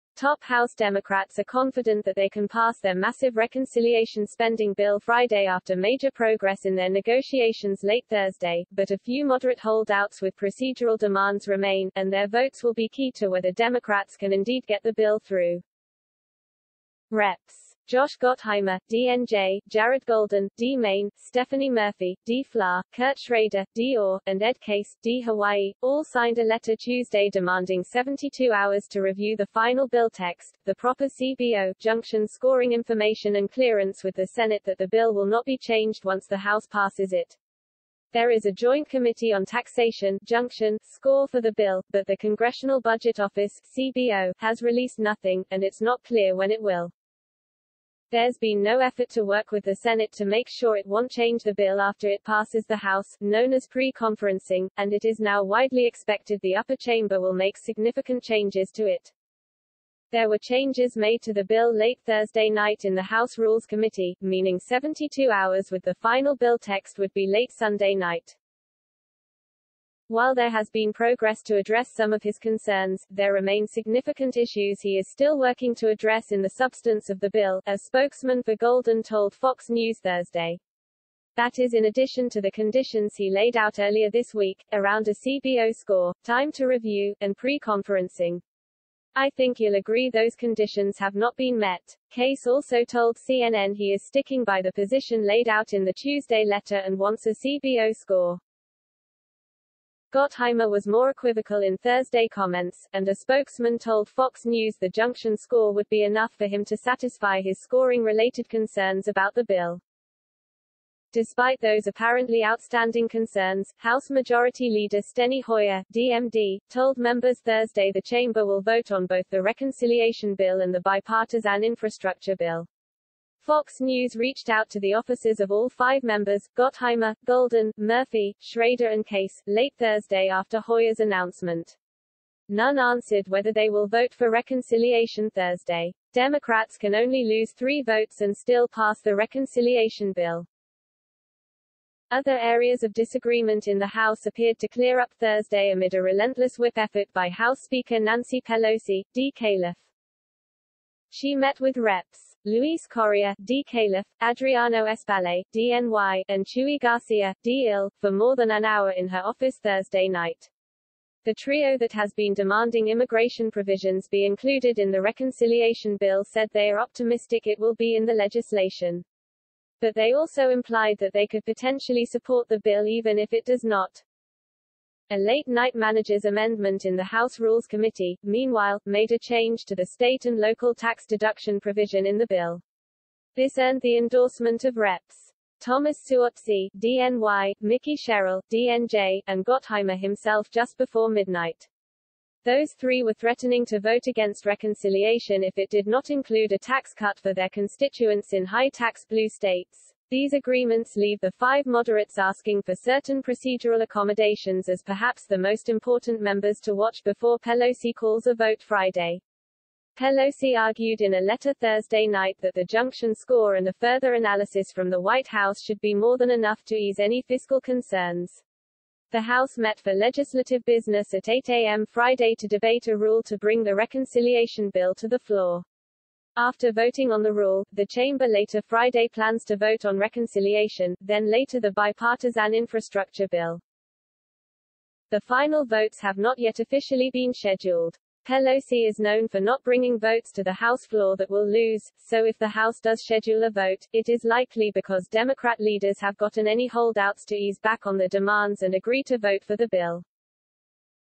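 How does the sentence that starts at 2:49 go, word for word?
But they also implied that they could potentially support the bill even if it does not.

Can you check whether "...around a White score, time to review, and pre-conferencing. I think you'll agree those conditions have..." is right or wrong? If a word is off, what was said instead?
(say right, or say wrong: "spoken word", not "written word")
wrong: "CBO", not "White".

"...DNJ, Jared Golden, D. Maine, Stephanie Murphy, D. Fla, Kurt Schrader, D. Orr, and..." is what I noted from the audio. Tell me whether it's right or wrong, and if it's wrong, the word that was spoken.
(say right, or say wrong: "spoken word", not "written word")
right.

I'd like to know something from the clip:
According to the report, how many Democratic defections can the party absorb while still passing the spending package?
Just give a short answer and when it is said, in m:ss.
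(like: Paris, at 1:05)
3, at 2:17.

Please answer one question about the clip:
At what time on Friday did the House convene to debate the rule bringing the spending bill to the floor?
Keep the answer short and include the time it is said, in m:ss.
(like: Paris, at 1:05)
8 a.m., at 3:41.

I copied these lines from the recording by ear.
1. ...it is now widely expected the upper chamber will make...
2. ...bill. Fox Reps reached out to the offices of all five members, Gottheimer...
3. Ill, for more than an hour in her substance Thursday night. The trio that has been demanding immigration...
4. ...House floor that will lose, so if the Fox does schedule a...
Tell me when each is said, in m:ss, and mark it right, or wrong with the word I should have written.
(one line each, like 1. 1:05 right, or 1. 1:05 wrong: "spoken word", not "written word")
1. 0:54 right
2. 2:02 wrong: "News", not "Reps"
3. 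2:37 wrong: "office", not "substance"
4. 4:00 wrong: "House", not "Fox".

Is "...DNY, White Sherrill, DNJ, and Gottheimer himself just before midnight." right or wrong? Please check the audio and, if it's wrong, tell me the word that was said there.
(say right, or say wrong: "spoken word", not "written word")
wrong: "Mikie", not "White".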